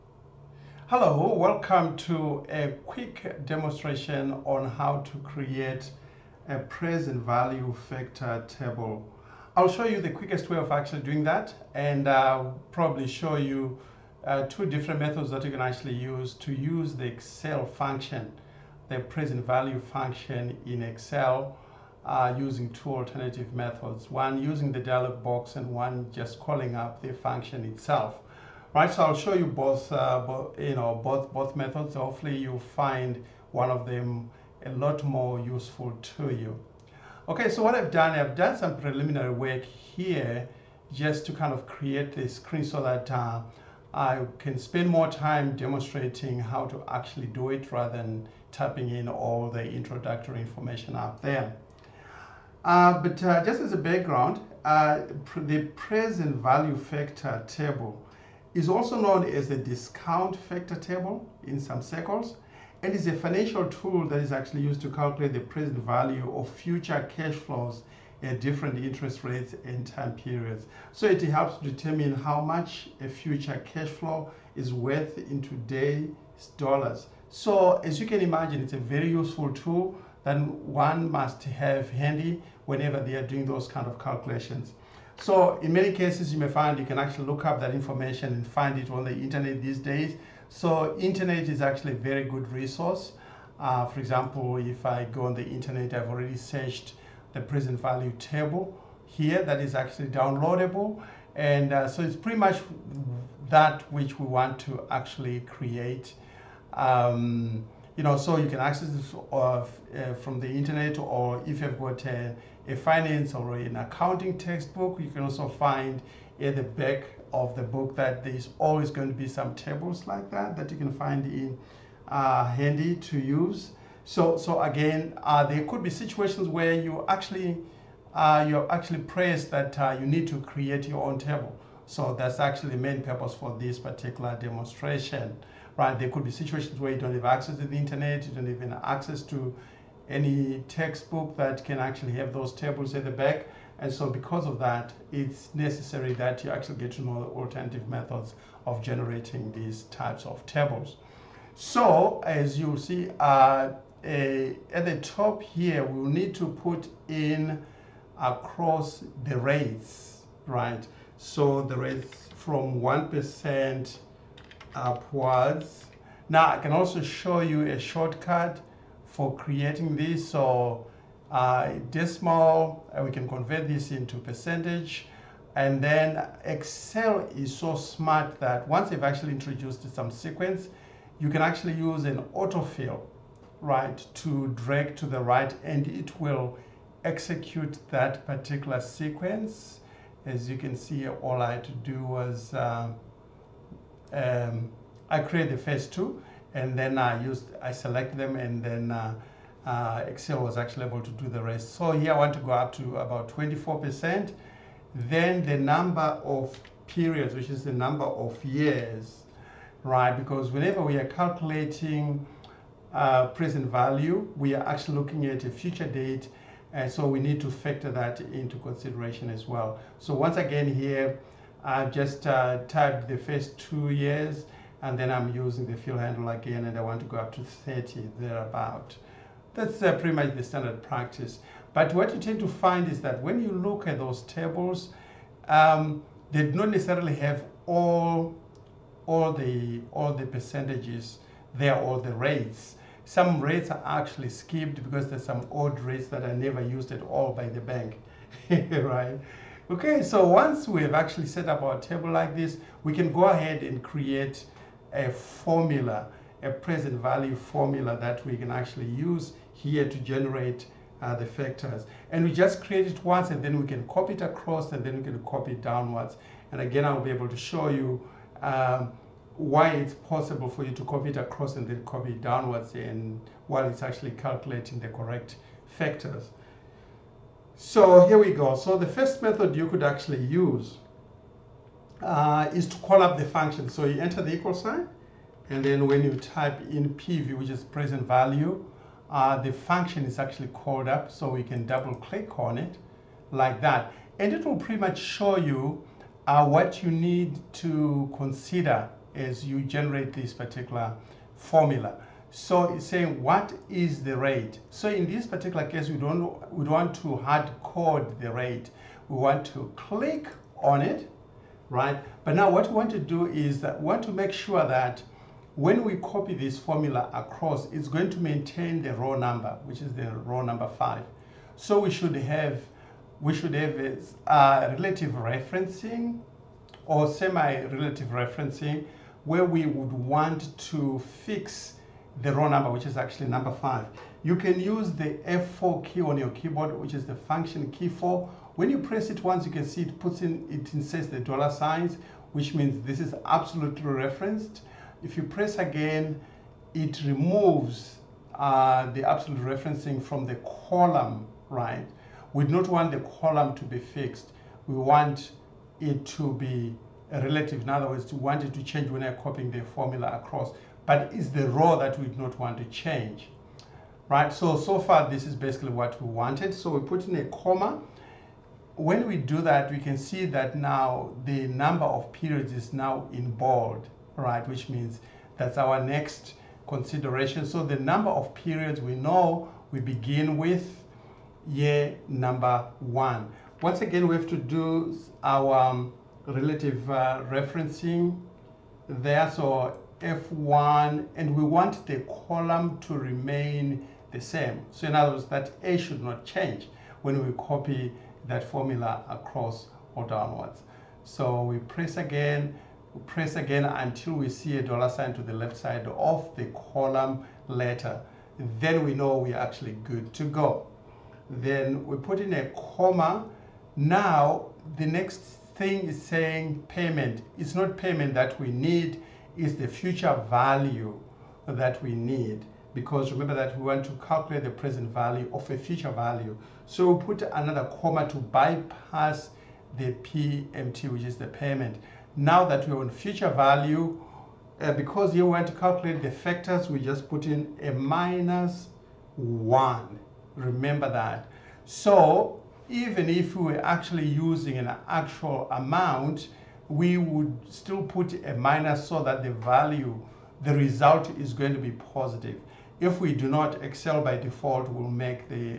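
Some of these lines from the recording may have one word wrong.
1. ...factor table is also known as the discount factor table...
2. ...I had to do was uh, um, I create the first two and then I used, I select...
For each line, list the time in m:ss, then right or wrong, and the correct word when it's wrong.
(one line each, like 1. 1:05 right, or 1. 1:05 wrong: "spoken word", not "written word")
1. 0:56 right
2. 3:11 right.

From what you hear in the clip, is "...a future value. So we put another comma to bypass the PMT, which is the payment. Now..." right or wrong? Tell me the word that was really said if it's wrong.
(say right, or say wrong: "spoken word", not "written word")
right.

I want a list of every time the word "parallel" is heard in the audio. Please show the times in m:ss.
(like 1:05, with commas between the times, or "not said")
not said.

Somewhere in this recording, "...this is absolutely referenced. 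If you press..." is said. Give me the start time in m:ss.
5:42.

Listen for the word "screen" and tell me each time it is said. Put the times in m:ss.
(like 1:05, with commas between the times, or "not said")
0:42.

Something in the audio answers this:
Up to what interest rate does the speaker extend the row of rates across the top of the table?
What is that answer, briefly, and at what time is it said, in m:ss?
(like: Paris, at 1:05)
24%, at 3:23.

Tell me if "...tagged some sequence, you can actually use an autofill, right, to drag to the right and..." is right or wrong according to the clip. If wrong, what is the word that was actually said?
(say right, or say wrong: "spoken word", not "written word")
wrong: "introduced", not "tagged".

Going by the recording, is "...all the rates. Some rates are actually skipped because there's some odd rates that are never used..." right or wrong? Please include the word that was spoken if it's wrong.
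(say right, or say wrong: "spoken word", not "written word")
right.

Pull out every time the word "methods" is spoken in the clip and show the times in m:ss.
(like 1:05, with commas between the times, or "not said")
0:14, 0:23, 0:31, 2:27, 4:39.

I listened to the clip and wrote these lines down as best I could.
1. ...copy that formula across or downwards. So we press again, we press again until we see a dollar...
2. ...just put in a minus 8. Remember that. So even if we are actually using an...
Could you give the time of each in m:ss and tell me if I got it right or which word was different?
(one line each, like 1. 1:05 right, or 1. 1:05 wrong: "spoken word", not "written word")
1. 6:37 right
2. 7:16 wrong: "1", not "8".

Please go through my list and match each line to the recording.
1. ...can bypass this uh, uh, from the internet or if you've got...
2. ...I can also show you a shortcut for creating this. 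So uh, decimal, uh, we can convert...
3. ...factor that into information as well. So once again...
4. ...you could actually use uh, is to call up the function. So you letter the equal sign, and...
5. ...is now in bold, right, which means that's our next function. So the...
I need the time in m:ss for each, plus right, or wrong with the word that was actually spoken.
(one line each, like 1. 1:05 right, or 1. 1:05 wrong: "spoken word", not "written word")
1. 1:48 wrong: "access", not "bypass"
2. 2:46 right
3. 3:37 wrong: "consideration", not "information"
4. 4:39 wrong: "enter", not "letter"
5. 6:12 wrong: "consideration", not "function".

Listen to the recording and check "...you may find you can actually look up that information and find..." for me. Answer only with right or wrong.
right.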